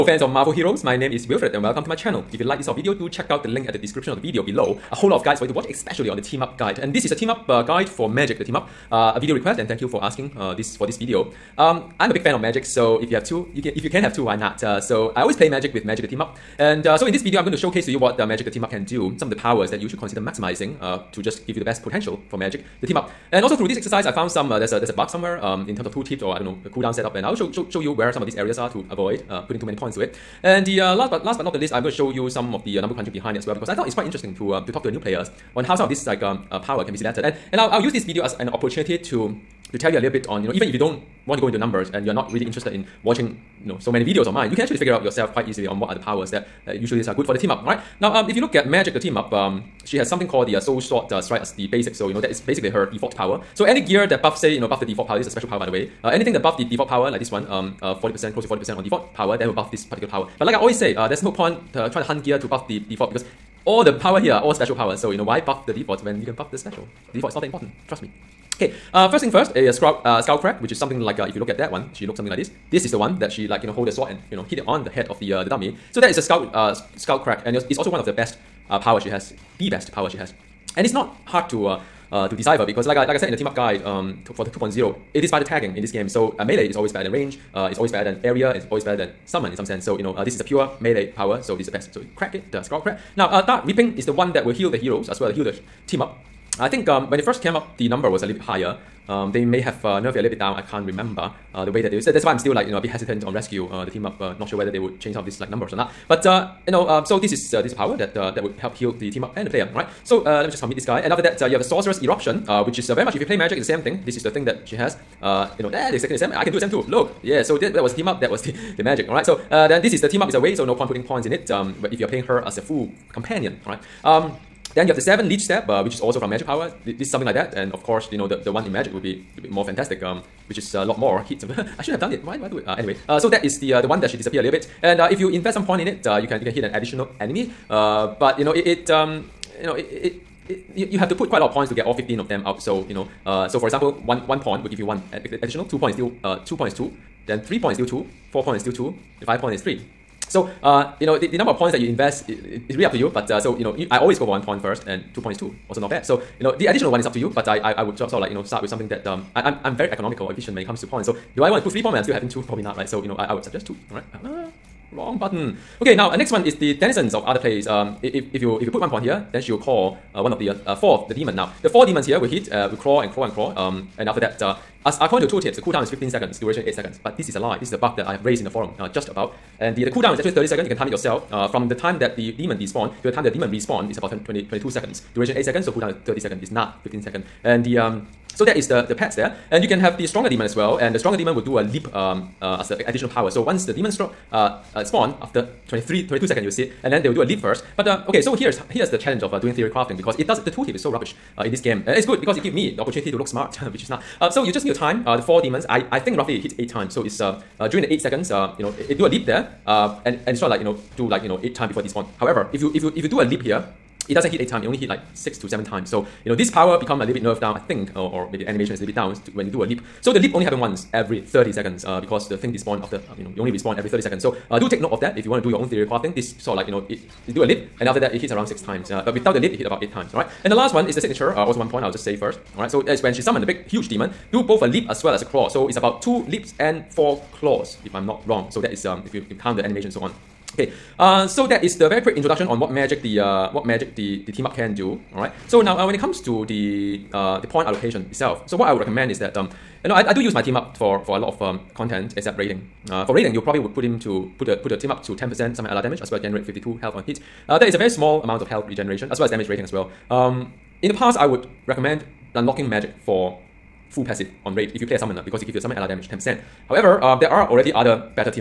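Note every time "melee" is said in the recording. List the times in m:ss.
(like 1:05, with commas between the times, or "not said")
1:26, 1:30.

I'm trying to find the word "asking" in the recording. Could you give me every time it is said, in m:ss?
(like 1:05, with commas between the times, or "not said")
0:10.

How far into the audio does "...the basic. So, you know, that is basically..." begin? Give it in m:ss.
0:51.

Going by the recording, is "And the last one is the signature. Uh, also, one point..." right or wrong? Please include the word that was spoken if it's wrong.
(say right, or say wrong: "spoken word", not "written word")
right.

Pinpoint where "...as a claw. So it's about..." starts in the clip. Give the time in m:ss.
3:55.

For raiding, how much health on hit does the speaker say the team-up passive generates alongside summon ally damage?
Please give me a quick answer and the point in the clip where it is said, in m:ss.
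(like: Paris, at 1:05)
52, at 4:16.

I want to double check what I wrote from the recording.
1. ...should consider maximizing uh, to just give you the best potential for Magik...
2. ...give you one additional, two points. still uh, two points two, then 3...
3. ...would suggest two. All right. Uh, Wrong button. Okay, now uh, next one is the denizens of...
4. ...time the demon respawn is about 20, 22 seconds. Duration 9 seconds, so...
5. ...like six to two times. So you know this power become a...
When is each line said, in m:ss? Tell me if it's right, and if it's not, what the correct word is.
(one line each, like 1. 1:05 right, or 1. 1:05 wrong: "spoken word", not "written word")
1. 0:19 right
2. 2:24 right
3. 2:43 right
4. 3:03 wrong: "8", not "9"
5. 3:34 wrong: "seven", not "two".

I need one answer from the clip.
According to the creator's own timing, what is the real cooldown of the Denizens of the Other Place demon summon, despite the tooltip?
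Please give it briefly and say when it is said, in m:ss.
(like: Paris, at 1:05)
30 seconds, at 2:59.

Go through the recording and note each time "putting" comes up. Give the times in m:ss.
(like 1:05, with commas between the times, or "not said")
0:29, 2:00.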